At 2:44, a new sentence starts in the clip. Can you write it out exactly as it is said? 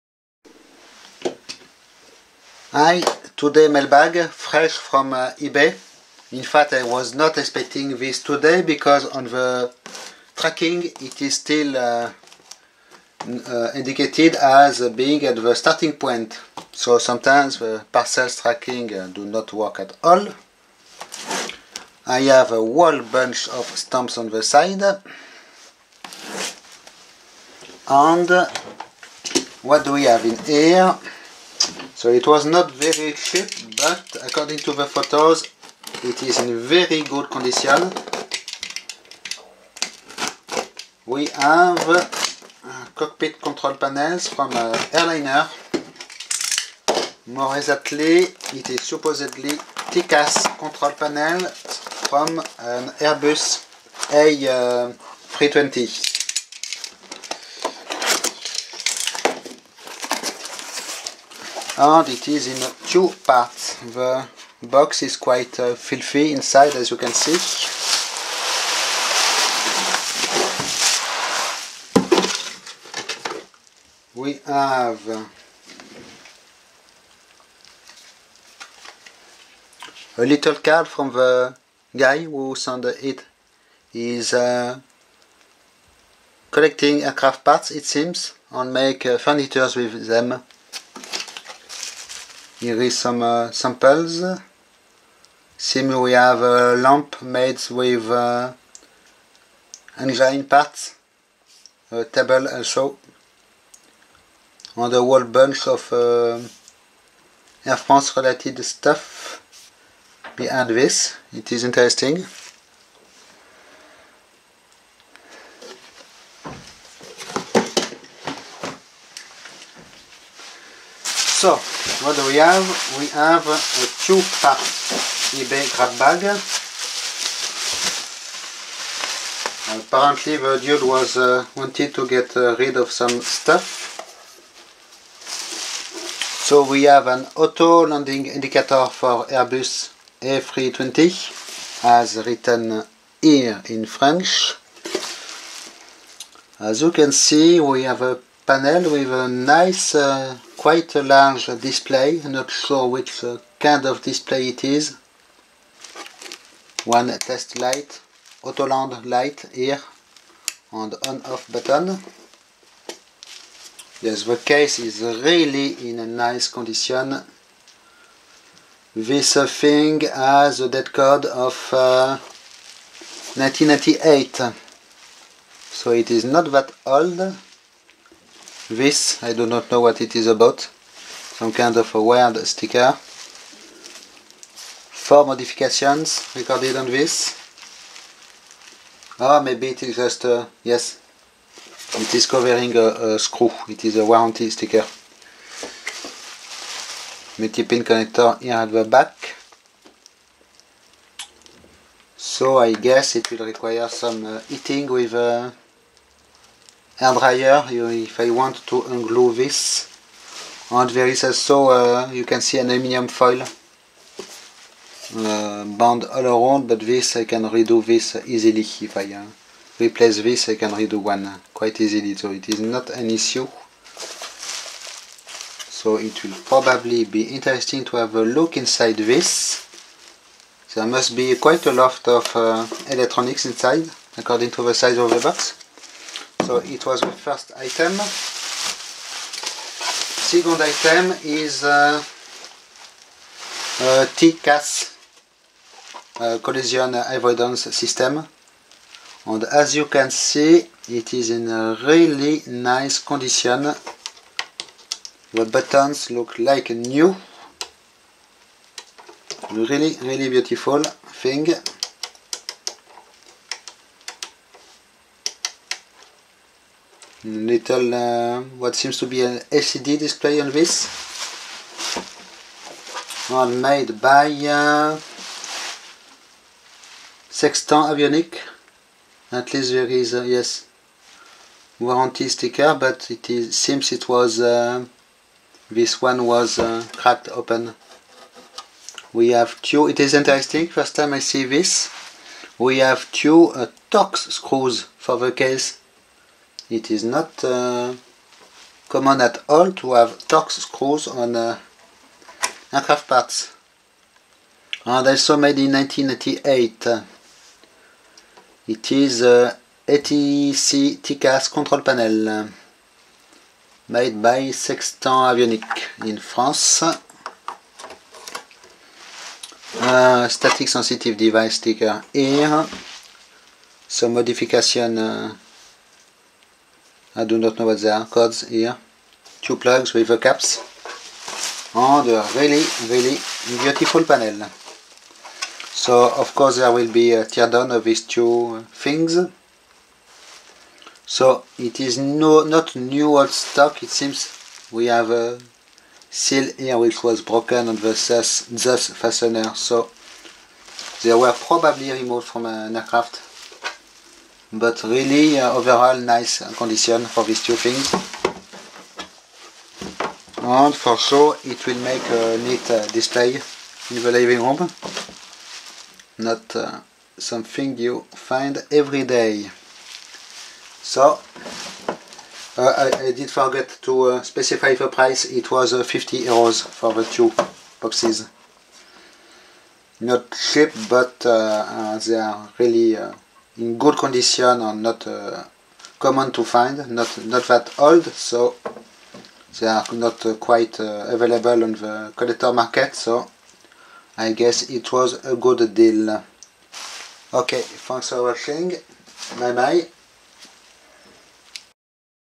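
Yes, the case is really in a nice condition.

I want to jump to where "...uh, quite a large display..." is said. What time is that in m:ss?
2:29.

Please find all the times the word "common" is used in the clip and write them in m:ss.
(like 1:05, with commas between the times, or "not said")
4:58, 6:25.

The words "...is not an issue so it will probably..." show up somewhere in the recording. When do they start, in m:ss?
3:42.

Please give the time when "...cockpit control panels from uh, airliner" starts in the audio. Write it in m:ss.
0:42.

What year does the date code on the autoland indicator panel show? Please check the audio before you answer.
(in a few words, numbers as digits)
1998.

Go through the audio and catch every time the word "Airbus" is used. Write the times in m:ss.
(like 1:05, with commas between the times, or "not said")
0:52, 2:19.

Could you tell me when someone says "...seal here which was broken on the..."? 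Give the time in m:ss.
5:46.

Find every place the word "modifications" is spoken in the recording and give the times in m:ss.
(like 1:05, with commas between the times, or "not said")
3:05, 5:24.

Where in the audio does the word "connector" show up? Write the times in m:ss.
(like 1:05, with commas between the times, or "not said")
3:17.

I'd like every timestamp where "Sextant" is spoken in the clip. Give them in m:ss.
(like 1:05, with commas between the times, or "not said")
4:37, 5:14.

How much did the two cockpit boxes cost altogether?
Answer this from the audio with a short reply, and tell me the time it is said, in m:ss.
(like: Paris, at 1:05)
50 euros, at 6:15.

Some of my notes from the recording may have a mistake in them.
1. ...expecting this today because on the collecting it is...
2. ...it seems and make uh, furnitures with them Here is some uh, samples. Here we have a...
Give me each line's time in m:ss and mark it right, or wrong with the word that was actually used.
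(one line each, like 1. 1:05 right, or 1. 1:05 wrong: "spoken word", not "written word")
1. 0:07 wrong: "tracking", not "collecting"
2. 1:27 right.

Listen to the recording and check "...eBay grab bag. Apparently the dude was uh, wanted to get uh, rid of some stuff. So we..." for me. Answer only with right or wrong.
right.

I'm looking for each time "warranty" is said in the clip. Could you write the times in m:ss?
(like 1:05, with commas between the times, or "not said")
3:14, 4:41.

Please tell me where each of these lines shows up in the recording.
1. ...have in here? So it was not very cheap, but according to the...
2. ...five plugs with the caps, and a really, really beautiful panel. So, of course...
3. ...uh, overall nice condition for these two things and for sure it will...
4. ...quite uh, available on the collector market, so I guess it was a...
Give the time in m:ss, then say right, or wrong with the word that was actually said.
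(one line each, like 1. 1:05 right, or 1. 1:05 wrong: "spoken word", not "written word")
1. 0:30 right
2. 5:29 wrong: "two", not "five"
3. 5:55 right
4. 6:30 right.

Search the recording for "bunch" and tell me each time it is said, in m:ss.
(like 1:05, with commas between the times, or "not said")
0:23, 1:45.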